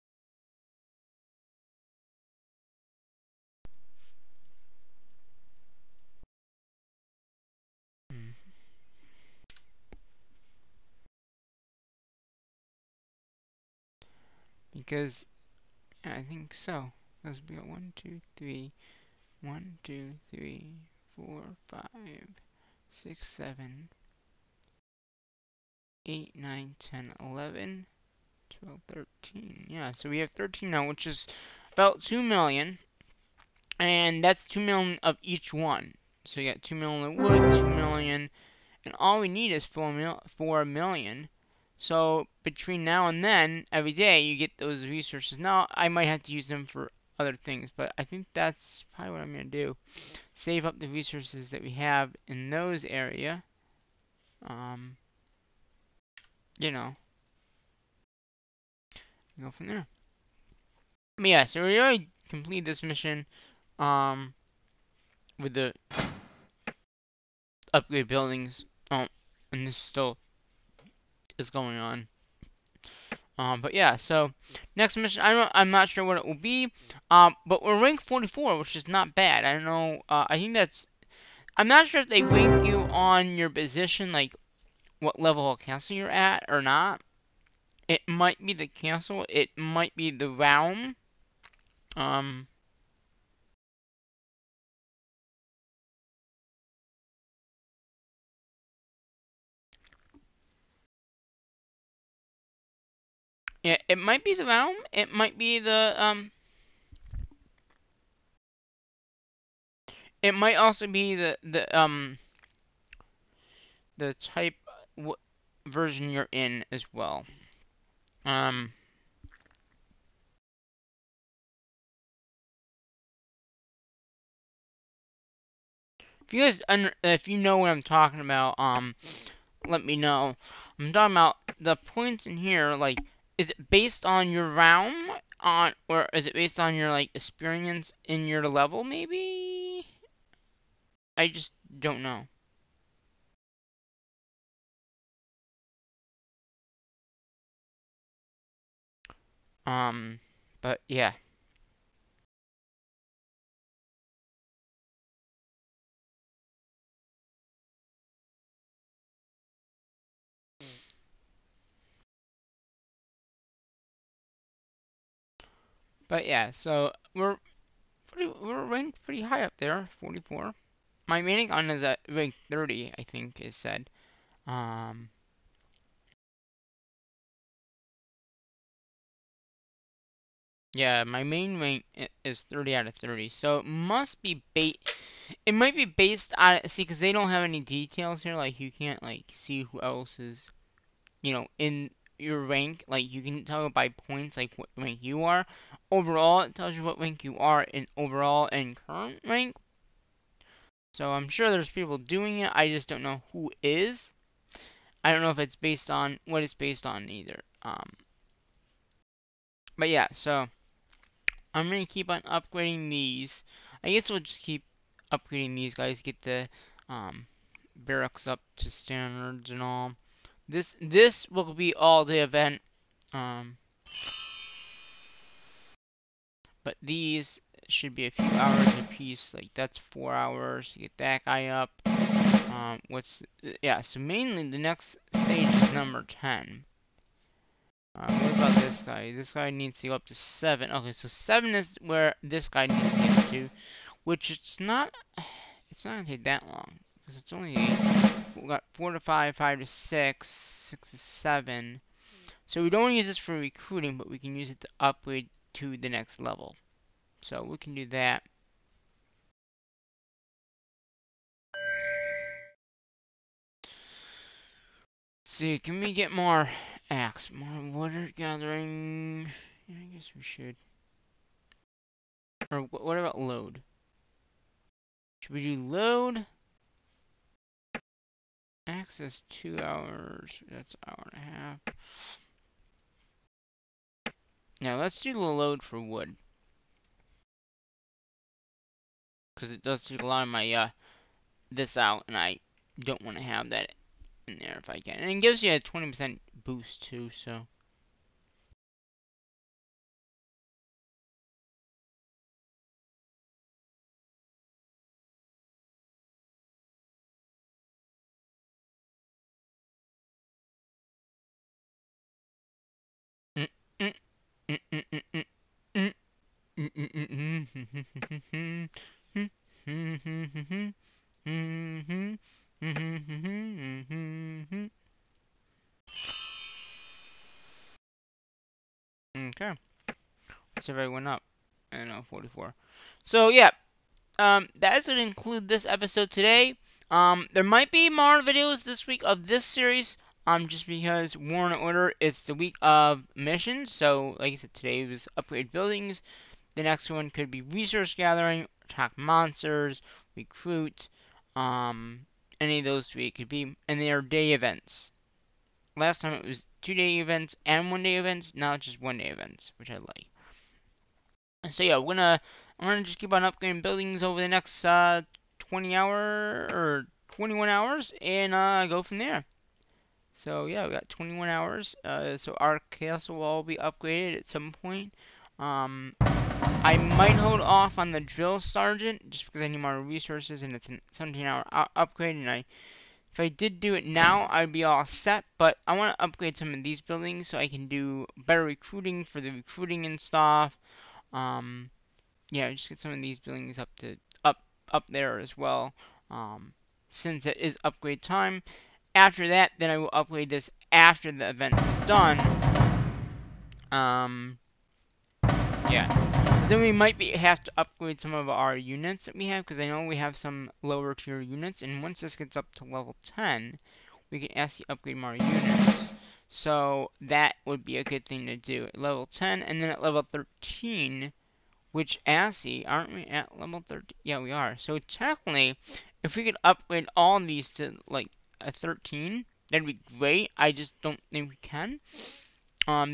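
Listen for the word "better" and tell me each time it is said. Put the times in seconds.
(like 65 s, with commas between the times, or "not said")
388 s.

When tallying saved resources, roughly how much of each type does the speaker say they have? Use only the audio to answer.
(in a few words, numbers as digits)
2 million.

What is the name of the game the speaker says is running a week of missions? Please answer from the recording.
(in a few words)
War and Order.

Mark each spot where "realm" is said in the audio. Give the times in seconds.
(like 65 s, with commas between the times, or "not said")
90 s, 104 s, 134 s.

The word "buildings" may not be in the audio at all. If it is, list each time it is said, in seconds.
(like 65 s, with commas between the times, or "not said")
68 s, 345 s, 363 s, 386 s, 393 s.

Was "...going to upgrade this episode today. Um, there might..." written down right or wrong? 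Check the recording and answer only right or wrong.
wrong.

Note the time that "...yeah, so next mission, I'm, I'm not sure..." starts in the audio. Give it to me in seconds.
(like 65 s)
73 s.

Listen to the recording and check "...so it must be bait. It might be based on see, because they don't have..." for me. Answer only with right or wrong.
right.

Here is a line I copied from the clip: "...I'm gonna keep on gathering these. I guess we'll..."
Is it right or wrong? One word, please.
wrong.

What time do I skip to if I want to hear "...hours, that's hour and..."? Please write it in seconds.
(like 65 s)
279 s.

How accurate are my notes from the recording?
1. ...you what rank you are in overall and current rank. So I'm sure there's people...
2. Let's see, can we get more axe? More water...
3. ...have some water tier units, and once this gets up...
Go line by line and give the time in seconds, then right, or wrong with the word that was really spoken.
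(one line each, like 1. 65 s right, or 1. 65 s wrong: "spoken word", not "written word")
1. 196 s right
2. 265 s right
3. 409 s wrong: "lower", not "water".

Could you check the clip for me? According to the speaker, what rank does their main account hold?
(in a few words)
30.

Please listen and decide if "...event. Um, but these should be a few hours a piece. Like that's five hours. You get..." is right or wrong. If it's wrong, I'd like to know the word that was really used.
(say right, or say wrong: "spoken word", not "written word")
wrong: "four", not "five".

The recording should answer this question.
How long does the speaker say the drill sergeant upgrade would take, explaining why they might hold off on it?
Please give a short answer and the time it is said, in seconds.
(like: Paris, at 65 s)
17 hours, at 380 s.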